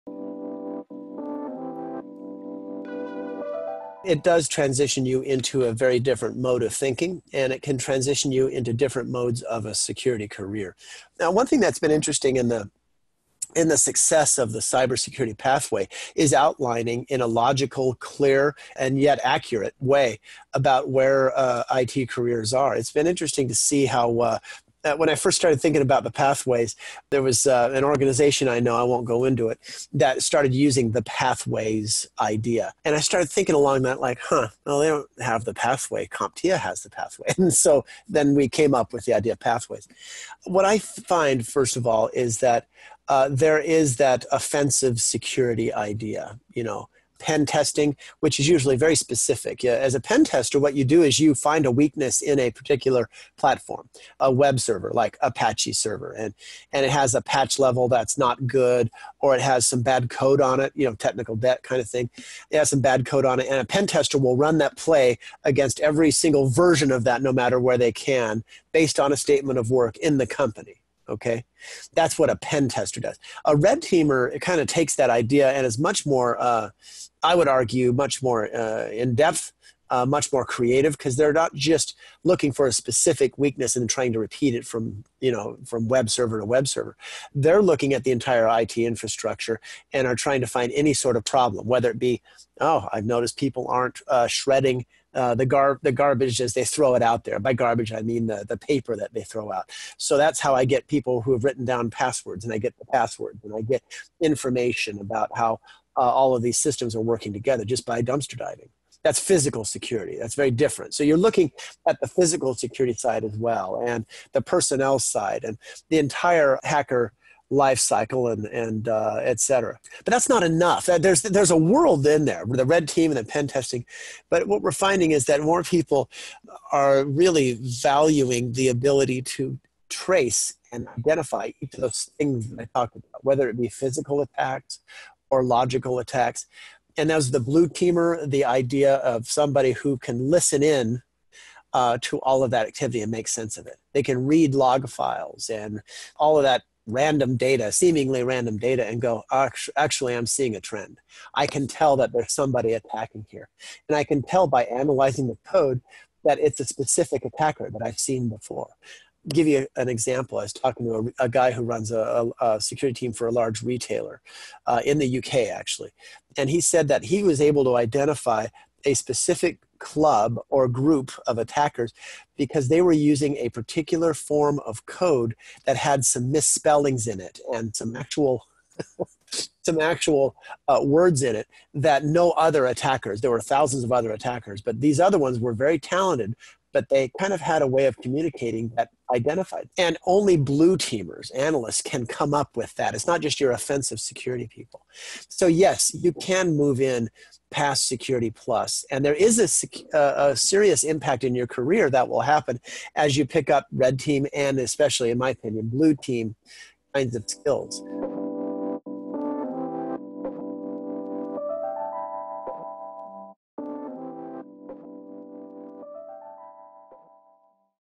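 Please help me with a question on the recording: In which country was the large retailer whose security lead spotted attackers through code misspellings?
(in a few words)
UK.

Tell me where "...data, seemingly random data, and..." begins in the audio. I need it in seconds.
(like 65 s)
147 s.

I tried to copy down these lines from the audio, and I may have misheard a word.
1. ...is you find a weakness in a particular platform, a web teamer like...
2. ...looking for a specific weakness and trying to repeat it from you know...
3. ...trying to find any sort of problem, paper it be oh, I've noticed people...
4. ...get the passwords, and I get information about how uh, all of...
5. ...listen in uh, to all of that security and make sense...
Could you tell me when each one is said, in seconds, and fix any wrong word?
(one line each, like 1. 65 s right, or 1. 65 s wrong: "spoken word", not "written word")
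1. 51 s wrong: "server", not "teamer"
2. 82 s right
3. 90 s wrong: "whether", not "paper"
4. 102 s right
5. 140 s wrong: "activity", not "security".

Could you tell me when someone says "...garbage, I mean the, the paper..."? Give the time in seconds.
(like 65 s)
97 s.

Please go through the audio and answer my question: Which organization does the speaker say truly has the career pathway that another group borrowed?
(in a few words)
CompTIA.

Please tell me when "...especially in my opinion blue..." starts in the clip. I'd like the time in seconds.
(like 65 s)
204 s.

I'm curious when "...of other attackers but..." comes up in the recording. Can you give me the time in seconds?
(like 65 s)
183 s.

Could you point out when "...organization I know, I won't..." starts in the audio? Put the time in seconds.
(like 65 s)
27 s.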